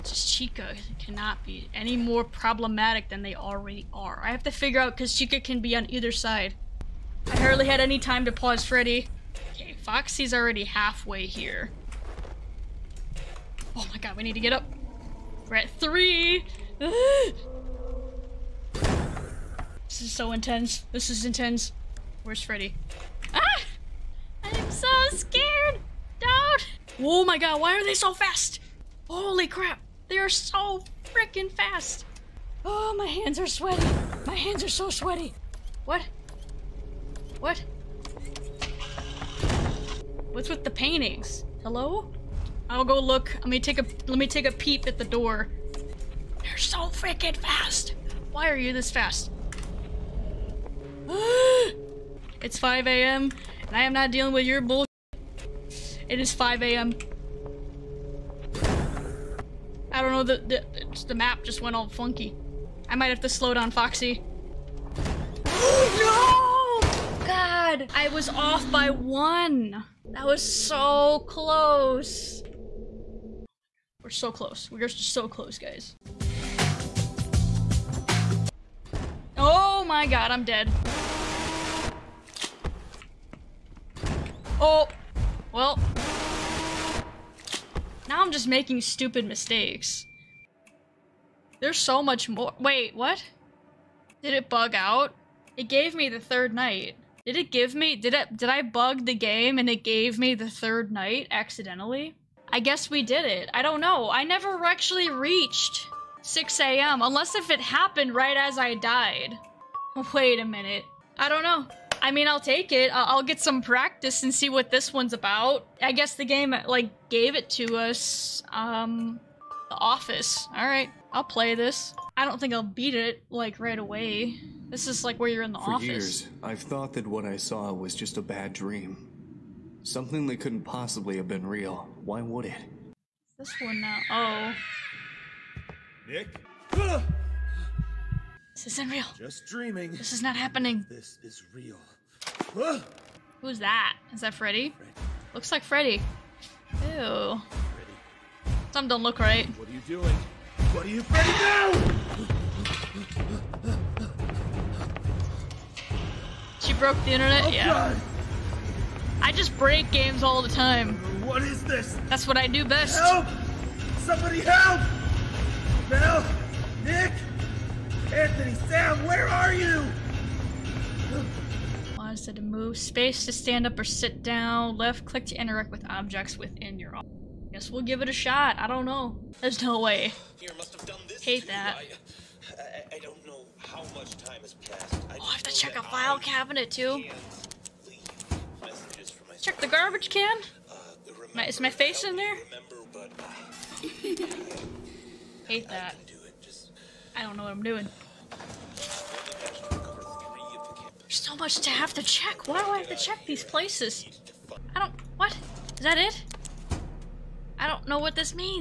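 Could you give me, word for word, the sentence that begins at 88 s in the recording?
Now I'm just making stupid mistakes.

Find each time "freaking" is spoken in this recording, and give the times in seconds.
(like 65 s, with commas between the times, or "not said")
31 s, 46 s.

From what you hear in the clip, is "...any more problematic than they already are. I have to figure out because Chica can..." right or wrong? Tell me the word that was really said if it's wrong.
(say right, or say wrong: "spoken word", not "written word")
right.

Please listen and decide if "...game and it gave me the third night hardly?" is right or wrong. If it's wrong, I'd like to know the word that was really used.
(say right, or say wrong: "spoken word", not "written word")
wrong: "accidentally", not "hardly".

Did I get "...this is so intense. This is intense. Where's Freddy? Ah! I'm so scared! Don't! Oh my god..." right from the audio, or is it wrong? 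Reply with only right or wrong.
right.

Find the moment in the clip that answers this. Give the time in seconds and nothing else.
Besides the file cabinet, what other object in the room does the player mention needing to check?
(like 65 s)
189 s.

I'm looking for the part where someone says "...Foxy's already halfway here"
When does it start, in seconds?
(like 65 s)
9 s.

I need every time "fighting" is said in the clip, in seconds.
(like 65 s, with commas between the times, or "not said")
not said.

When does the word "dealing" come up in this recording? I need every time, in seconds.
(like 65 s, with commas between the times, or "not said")
54 s.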